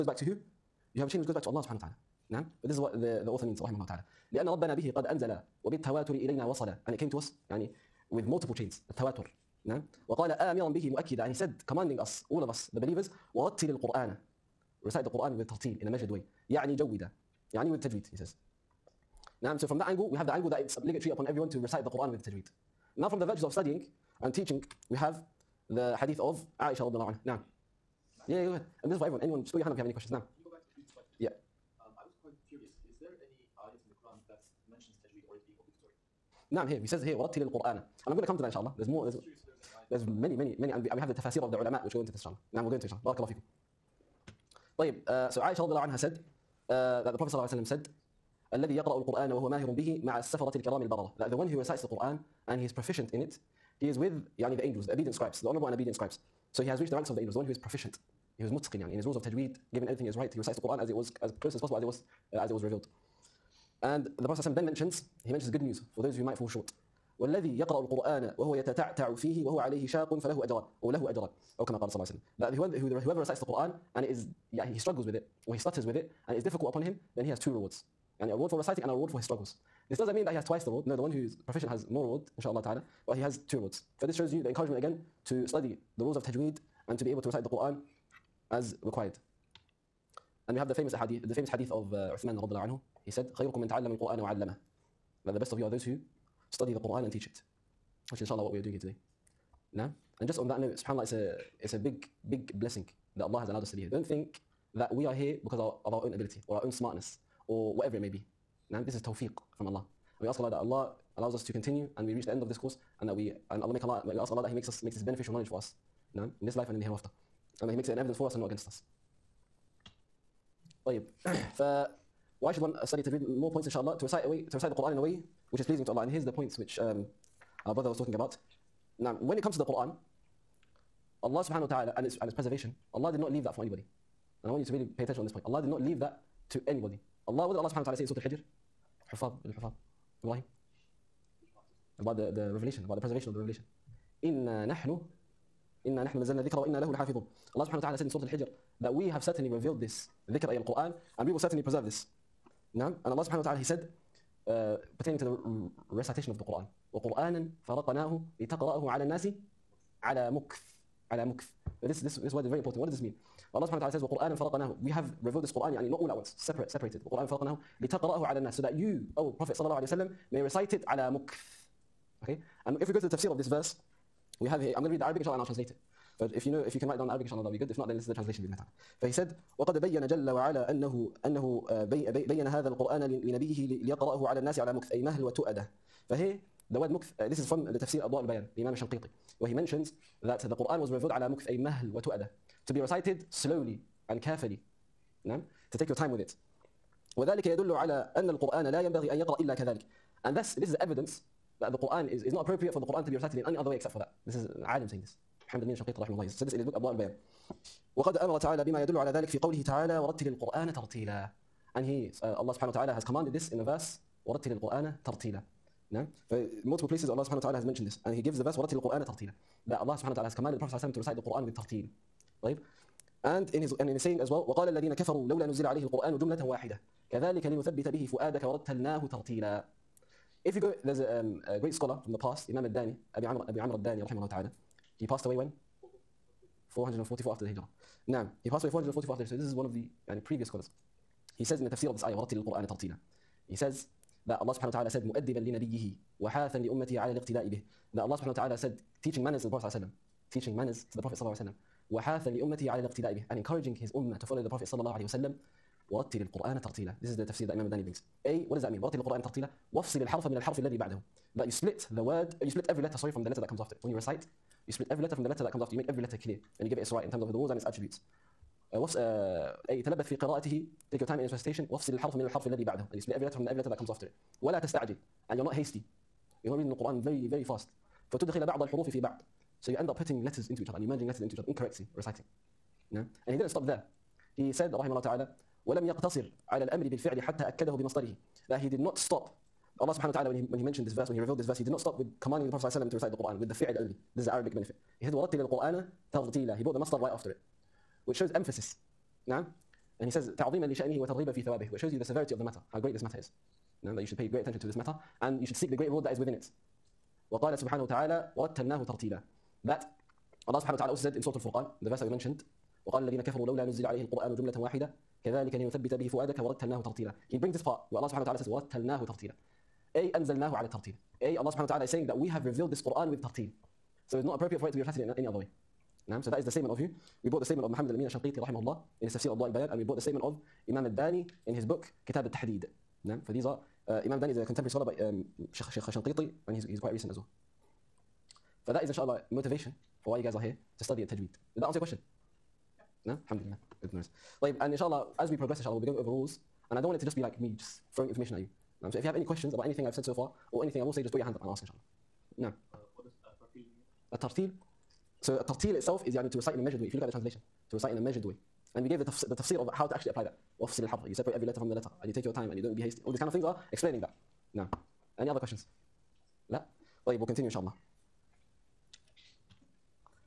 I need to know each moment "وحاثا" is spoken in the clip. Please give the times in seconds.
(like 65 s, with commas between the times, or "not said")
246 s, 251 s.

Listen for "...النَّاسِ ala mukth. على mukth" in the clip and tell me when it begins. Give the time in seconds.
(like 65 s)
159 s.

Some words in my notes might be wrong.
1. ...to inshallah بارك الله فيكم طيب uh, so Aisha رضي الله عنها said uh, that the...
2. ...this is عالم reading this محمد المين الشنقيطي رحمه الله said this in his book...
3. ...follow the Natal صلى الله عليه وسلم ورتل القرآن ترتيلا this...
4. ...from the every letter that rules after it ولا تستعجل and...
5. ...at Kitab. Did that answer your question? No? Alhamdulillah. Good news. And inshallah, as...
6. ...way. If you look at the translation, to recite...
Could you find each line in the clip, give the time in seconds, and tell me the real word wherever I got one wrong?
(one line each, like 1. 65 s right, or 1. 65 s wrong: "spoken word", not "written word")
1. 42 s right
2. 204 s wrong: "saying", not "reading"
3. 254 s wrong: "Prophet", not "Natal"
4. 273 s wrong: "comes", not "rules"
5. 341 s wrong: "Tajweed", not "Kitab"
6. 356 s right.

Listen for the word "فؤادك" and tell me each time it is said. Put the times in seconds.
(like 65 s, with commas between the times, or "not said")
228 s, 316 s.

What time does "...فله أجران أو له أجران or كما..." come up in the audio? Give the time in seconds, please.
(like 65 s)
70 s.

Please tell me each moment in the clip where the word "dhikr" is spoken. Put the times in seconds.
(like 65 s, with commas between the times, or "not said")
150 s.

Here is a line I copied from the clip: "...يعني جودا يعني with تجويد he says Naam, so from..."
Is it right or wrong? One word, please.
right.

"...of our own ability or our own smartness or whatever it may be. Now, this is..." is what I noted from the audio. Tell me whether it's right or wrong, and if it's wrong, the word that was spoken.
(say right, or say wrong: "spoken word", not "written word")
right.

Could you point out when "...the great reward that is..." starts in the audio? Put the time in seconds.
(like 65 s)
305 s.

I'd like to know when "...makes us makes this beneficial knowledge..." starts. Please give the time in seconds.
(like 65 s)
114 s.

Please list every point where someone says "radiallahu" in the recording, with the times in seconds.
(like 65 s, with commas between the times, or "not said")
26 s, 92 s.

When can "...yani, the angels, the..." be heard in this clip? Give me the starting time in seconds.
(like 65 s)
54 s.